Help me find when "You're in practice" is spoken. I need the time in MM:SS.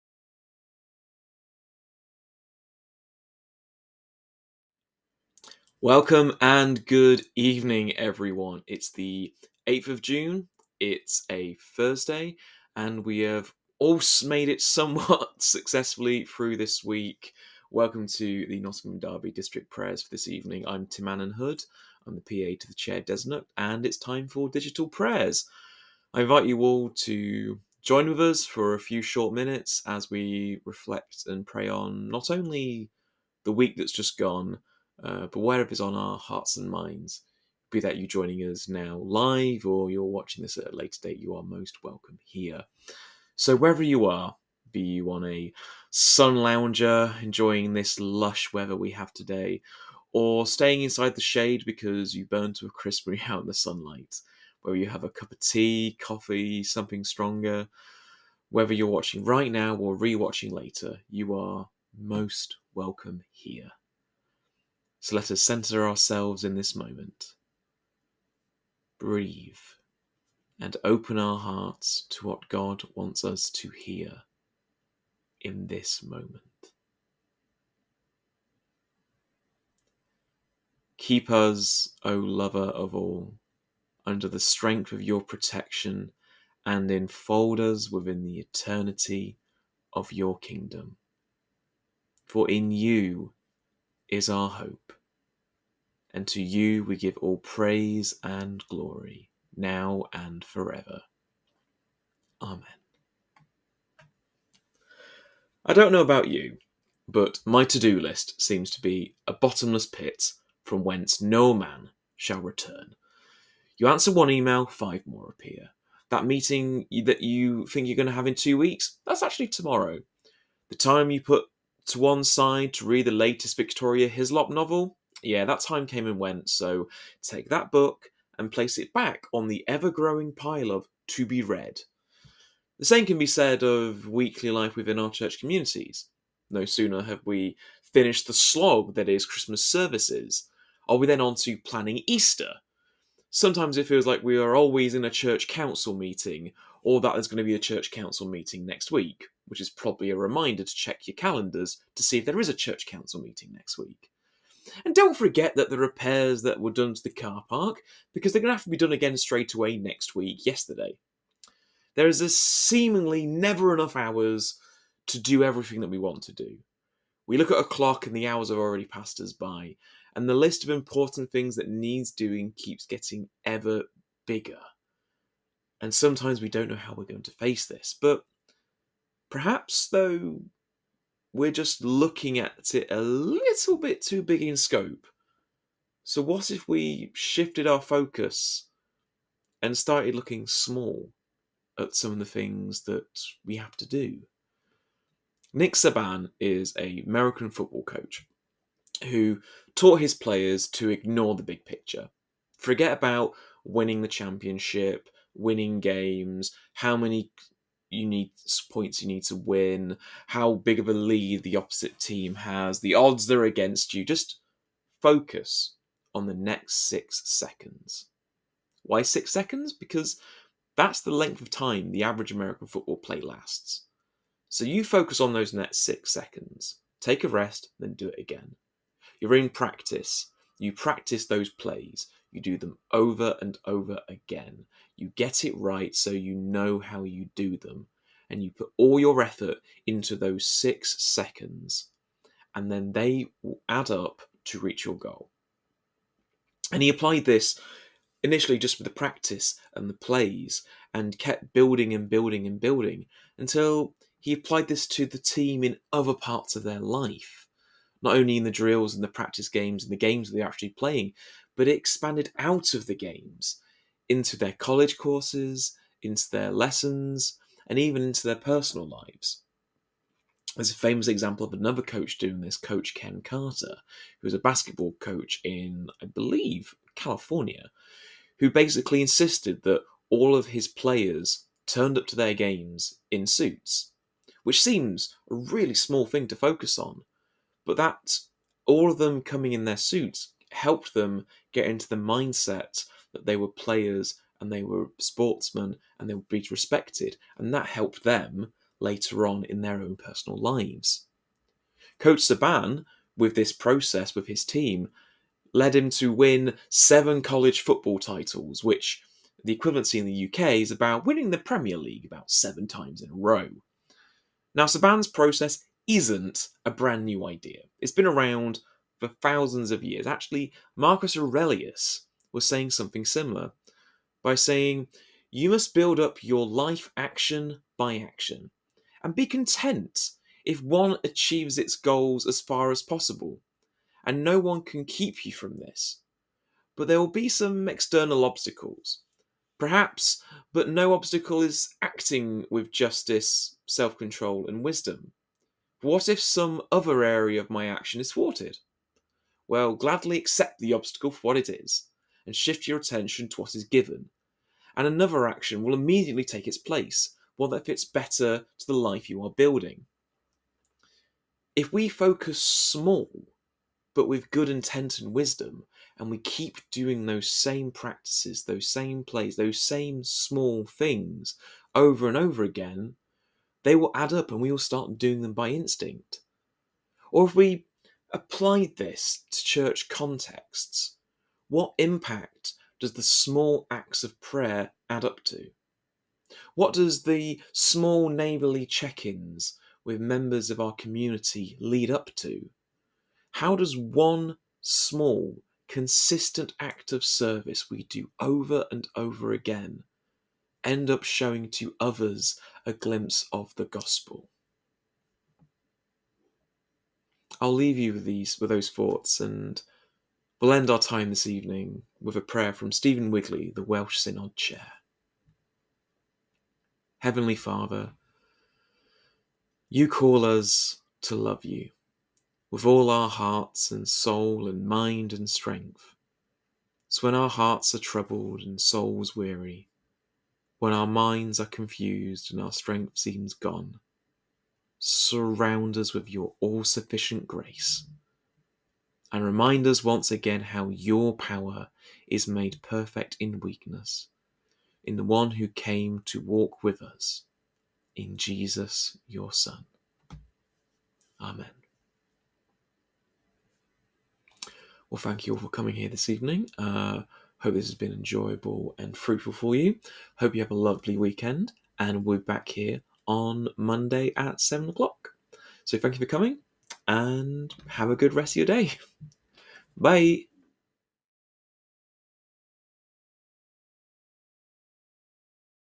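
03:49.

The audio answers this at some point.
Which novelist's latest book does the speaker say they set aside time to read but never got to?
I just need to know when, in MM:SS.
02:03.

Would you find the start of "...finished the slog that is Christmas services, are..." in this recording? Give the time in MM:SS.
02:17.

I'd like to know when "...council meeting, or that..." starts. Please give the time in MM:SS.
02:25.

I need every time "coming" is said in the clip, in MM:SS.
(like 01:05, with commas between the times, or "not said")
04:49, 07:35, 07:46.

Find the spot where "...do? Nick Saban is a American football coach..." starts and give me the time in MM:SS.
03:13.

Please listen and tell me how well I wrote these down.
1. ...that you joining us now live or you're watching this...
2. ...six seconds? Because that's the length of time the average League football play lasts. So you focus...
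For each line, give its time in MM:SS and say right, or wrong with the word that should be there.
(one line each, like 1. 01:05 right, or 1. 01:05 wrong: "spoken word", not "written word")
1. 00:37 right
2. 03:39 wrong: "American", not "League".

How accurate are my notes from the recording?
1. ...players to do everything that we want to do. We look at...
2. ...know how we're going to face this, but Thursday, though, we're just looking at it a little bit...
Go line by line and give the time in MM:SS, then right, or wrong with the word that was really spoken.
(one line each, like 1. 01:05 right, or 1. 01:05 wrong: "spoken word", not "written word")
1. 02:43 wrong: "hours", not "players"
2. 02:56 wrong: "Perhaps", not "Thursday".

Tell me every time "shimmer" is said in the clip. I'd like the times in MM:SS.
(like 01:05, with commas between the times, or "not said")
not said.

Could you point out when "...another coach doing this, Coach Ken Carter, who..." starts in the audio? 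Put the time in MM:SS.
04:31.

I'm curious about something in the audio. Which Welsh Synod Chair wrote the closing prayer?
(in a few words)
Stephen Wigley.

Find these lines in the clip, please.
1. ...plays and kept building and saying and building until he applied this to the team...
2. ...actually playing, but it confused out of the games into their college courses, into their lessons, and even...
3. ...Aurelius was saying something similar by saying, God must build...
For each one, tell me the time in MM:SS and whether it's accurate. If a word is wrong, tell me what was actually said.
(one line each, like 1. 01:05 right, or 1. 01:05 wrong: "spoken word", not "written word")
1. 04:09 wrong: "building", not "saying"
2. 04:20 wrong: "expanded", not "confused"
3. 05:21 wrong: "You", not "God".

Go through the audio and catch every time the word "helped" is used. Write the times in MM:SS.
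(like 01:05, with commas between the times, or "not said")
04:50, 04:57.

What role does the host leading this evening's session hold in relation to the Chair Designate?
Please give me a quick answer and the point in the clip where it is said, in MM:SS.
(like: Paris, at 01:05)
PA, at 00:22.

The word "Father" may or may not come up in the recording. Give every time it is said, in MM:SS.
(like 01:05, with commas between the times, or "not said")
06:57.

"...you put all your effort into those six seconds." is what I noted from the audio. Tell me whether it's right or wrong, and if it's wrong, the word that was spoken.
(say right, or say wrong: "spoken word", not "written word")
right.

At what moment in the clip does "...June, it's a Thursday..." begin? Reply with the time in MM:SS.
00:10.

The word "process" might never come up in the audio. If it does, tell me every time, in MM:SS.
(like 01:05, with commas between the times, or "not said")
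05:03, 05:15.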